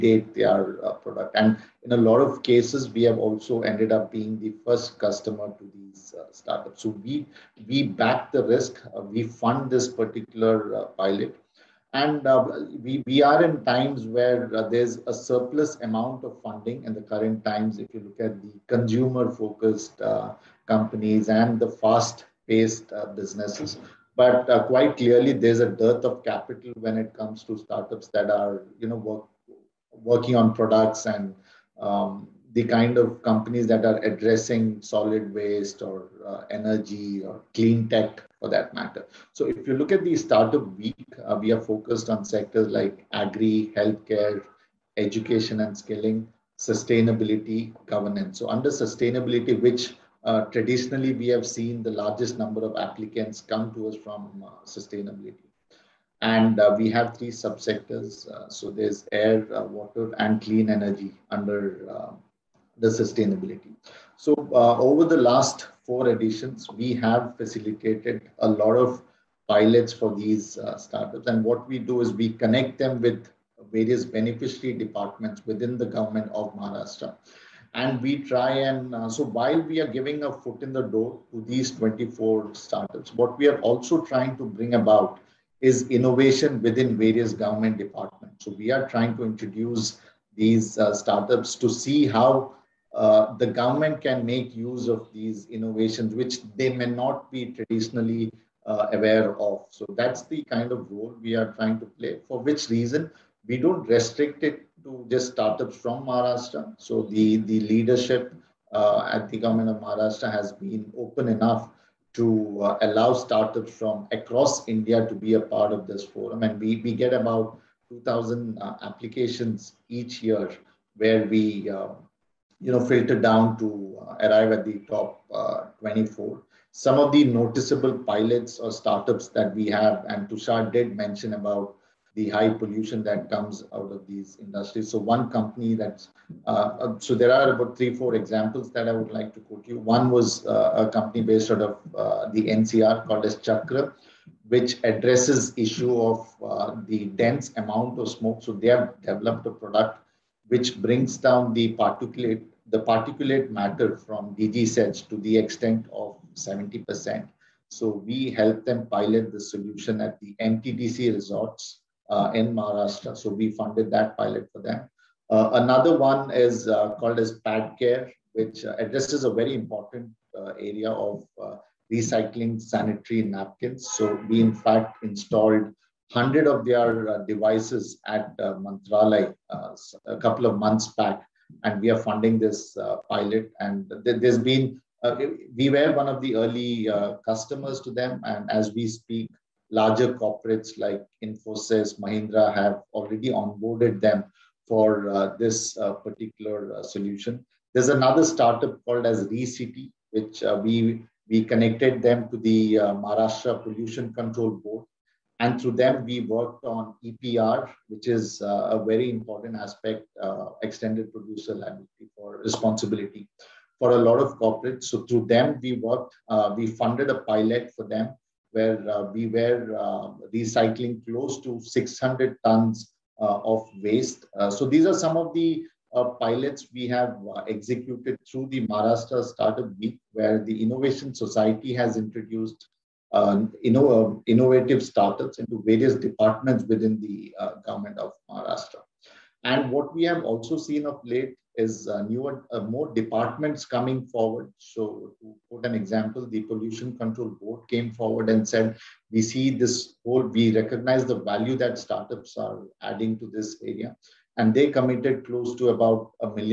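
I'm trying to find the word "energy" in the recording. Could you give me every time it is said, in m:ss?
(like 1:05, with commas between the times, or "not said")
0:36, 1:00.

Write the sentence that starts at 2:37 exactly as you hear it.
So we help them pilot the solution at the MTDC resorts uh, in Maharashtra.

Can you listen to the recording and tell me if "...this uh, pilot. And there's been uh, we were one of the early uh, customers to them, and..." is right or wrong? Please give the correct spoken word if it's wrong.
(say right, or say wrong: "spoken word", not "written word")
right.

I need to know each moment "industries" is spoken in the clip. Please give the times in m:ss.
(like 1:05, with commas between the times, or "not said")
2:14.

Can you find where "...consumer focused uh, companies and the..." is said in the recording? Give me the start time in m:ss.
0:18.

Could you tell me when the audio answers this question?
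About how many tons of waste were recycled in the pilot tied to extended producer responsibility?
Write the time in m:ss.
3:41.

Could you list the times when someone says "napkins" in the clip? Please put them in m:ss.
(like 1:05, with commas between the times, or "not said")
2:53.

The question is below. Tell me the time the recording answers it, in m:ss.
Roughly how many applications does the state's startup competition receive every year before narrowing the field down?
1:57.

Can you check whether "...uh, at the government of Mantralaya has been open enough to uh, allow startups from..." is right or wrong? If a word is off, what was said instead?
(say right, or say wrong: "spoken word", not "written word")
wrong: "Maharashtra", not "Mantralaya".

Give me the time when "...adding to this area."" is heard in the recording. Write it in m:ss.
4:12.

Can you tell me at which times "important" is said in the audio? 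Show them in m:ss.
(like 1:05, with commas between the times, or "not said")
2:49, 3:29.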